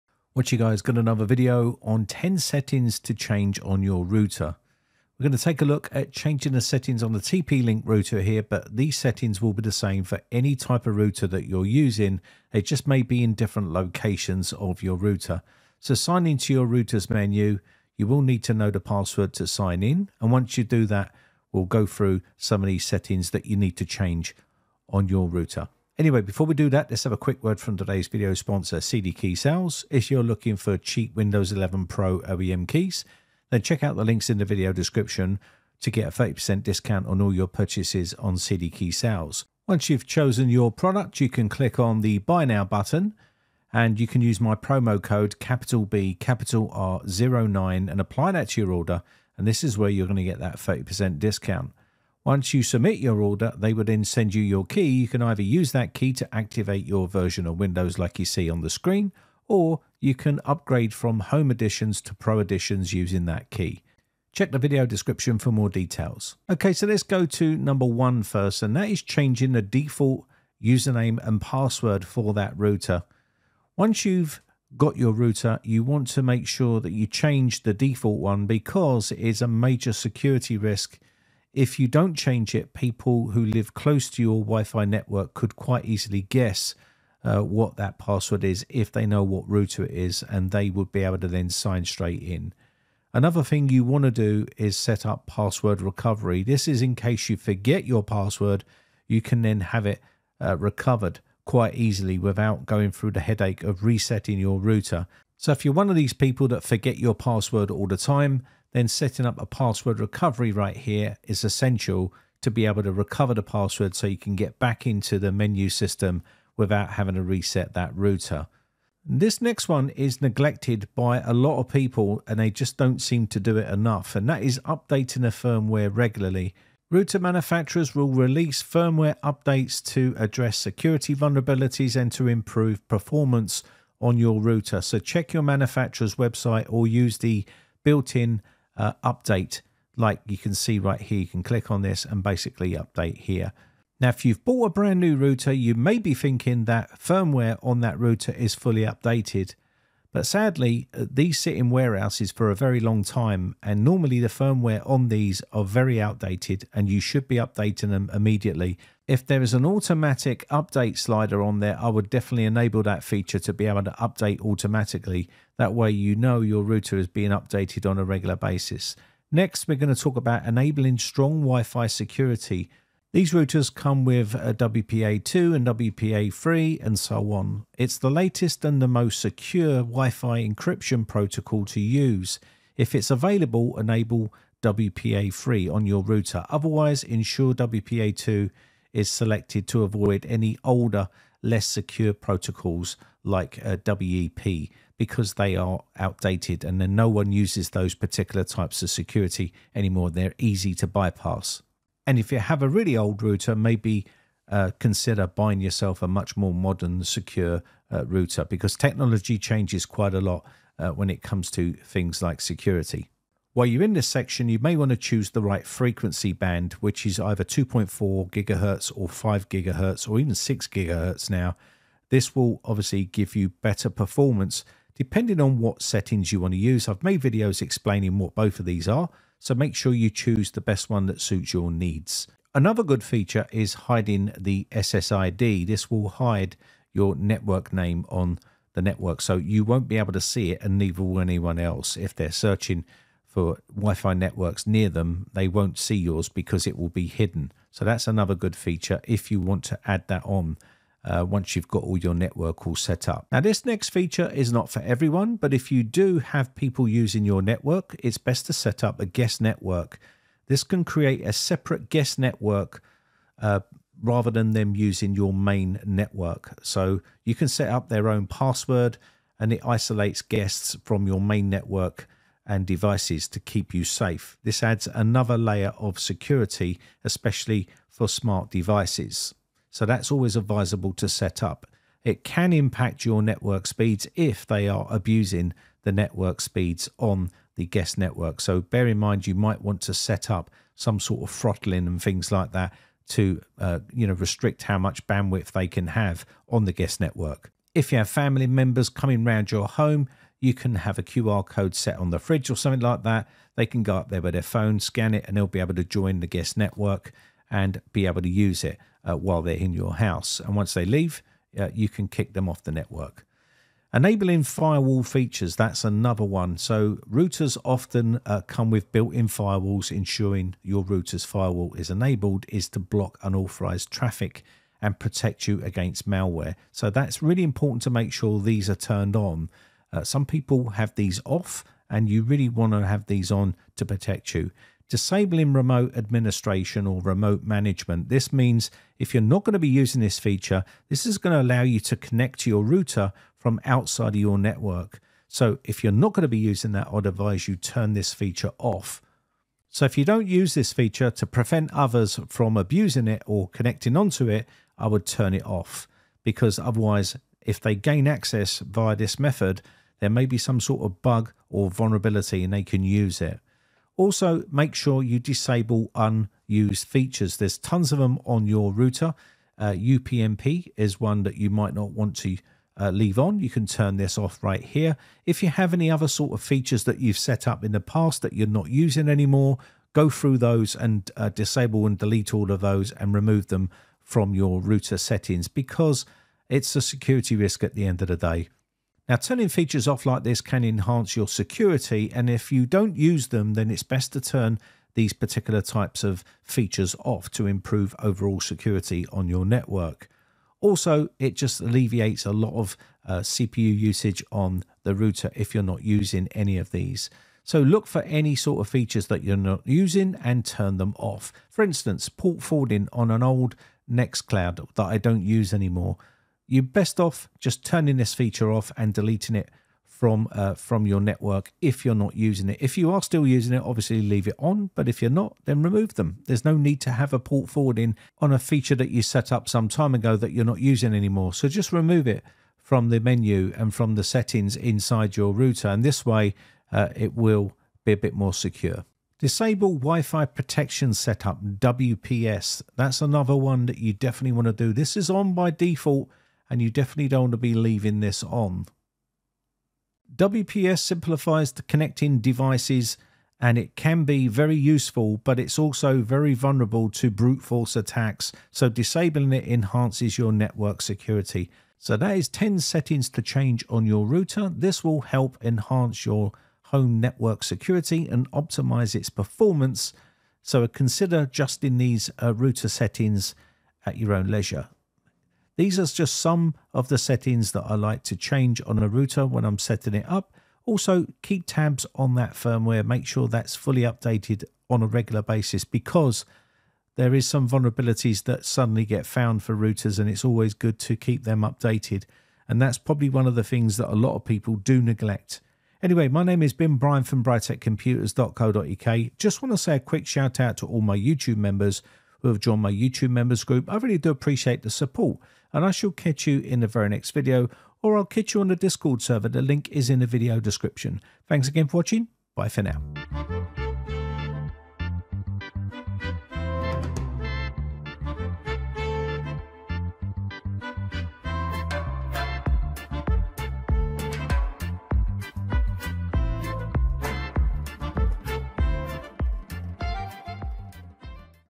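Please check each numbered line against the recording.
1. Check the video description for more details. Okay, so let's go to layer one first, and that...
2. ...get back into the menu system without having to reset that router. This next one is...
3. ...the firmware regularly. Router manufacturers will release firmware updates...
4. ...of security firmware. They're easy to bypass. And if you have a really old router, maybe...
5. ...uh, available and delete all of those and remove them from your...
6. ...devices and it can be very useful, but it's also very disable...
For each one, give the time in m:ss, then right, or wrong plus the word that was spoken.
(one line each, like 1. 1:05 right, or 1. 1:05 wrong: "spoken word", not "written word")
1. 1:04 wrong: "number", not "layer"
2. 1:54 right
3. 2:05 right
4. 3:18 wrong: "anymore", not "firmware"
5. 6:21 wrong: "disable", not "available"
6. 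7:32 wrong: "vulnerable", not "disable".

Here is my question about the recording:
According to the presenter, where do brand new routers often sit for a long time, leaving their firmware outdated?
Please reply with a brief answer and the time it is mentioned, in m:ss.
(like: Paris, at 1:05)
Warehouses, at 2:31.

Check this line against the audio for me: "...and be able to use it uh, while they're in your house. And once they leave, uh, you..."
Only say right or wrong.
right.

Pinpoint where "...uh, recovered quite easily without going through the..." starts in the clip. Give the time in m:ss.
1:40.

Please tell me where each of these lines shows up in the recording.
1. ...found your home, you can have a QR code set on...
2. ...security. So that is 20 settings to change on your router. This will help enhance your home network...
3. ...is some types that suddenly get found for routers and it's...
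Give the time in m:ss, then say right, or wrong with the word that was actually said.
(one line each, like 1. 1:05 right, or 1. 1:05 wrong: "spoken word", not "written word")
1. 4:59 wrong: "round", not "found"
2. 7:40 wrong: "10", not "20"
3. 8:07 wrong: "vulnerabilities", not "types".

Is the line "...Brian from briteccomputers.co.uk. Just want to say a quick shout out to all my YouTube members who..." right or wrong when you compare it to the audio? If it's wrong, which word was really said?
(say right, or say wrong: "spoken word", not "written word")
right.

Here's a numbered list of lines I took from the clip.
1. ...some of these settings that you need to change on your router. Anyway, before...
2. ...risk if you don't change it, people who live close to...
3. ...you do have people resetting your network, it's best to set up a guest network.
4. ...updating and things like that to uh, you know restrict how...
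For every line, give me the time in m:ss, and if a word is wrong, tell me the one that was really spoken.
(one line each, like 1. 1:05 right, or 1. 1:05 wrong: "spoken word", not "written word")
1. 0:22 right
2. 1:20 right
3. 4:15 wrong: "using", not "resetting"
4. 4:51 wrong: "throttling", not "updating".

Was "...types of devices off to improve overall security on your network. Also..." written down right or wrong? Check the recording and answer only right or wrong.
wrong.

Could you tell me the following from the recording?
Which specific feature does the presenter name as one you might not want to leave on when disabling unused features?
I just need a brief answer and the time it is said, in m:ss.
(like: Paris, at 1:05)
UPnP, at 6:09.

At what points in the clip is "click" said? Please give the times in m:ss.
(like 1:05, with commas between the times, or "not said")
0:41, 2:21.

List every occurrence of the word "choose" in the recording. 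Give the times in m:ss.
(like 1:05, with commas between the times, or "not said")
3:34, 3:50.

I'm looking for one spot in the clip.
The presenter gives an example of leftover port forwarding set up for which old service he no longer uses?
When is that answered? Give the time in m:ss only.
6:53.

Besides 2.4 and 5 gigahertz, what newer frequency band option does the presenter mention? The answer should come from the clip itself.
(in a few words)
6 gigahertz.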